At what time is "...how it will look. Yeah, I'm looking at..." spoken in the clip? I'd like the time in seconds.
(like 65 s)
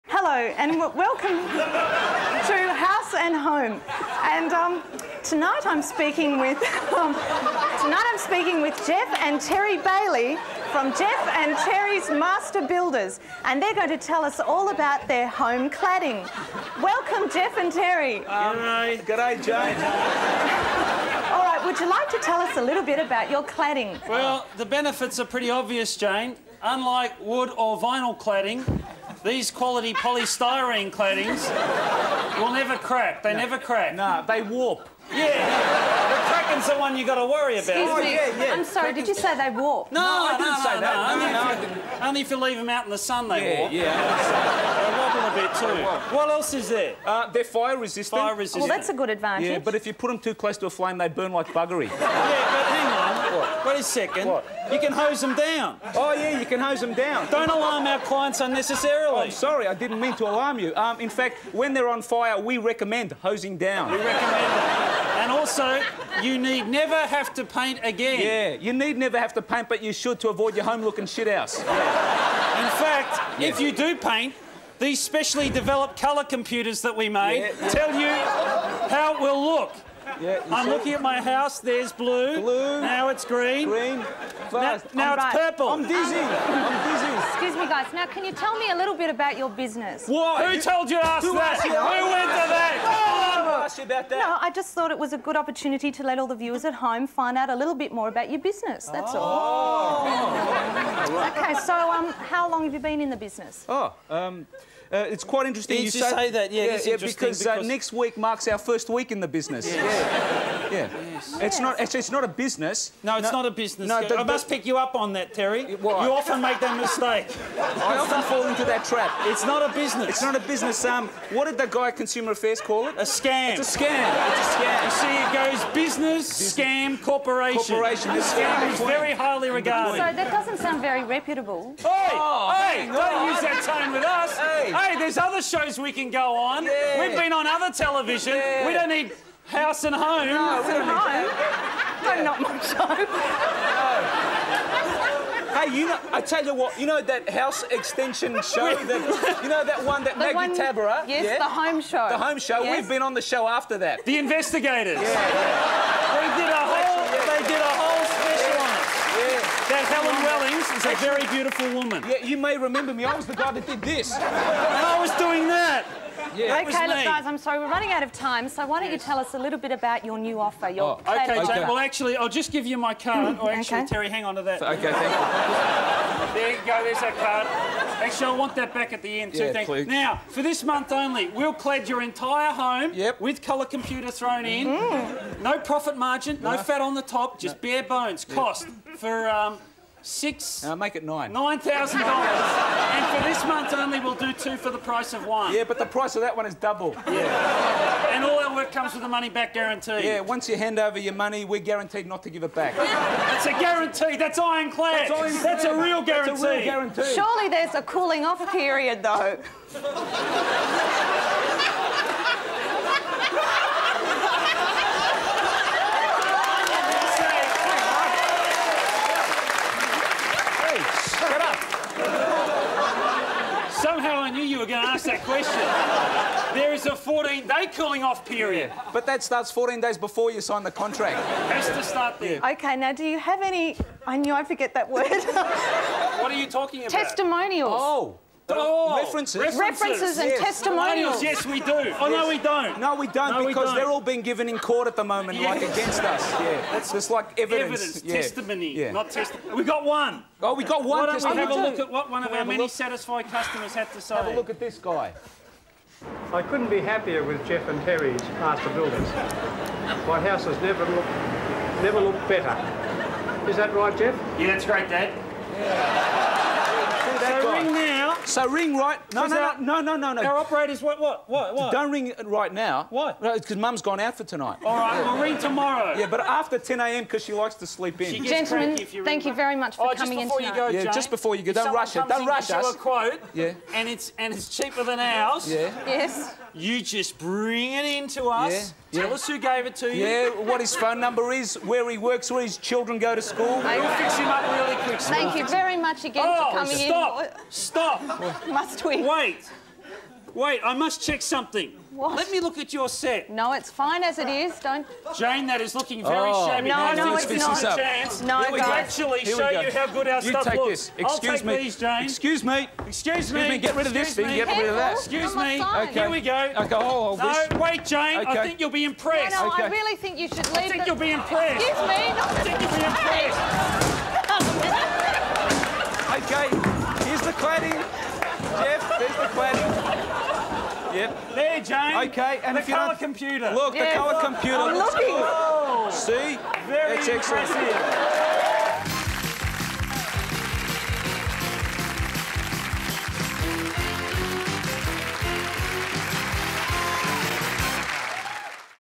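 78 s.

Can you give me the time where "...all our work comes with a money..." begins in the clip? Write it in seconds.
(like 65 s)
198 s.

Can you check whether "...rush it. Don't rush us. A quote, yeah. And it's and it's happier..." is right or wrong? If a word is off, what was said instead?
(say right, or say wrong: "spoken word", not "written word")
wrong: "cheaper", not "happier".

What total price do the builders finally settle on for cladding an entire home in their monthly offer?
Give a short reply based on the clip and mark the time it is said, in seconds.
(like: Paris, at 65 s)
$9,000, at 191 s.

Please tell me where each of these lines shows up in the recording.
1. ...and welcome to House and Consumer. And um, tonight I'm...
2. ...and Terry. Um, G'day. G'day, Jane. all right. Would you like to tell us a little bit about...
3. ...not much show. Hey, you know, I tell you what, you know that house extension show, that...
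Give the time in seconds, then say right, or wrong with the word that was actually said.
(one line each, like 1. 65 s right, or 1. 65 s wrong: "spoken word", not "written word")
1. 0 s wrong: "Home", not "Consumer"
2. 17 s right
3. 142 s right.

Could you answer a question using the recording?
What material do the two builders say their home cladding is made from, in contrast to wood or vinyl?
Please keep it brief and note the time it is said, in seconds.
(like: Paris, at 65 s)
polystyrene, at 29 s.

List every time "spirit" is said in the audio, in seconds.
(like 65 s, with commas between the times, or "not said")
not said.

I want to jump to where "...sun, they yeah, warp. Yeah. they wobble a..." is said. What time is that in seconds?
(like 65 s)
42 s.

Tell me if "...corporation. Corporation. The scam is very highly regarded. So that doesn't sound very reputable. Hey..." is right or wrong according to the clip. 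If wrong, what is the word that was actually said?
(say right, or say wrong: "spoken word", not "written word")
right.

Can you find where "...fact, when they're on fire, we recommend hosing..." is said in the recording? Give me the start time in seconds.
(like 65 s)
61 s.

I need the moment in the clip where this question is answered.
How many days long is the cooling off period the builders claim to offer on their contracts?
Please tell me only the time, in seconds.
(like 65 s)
226 s.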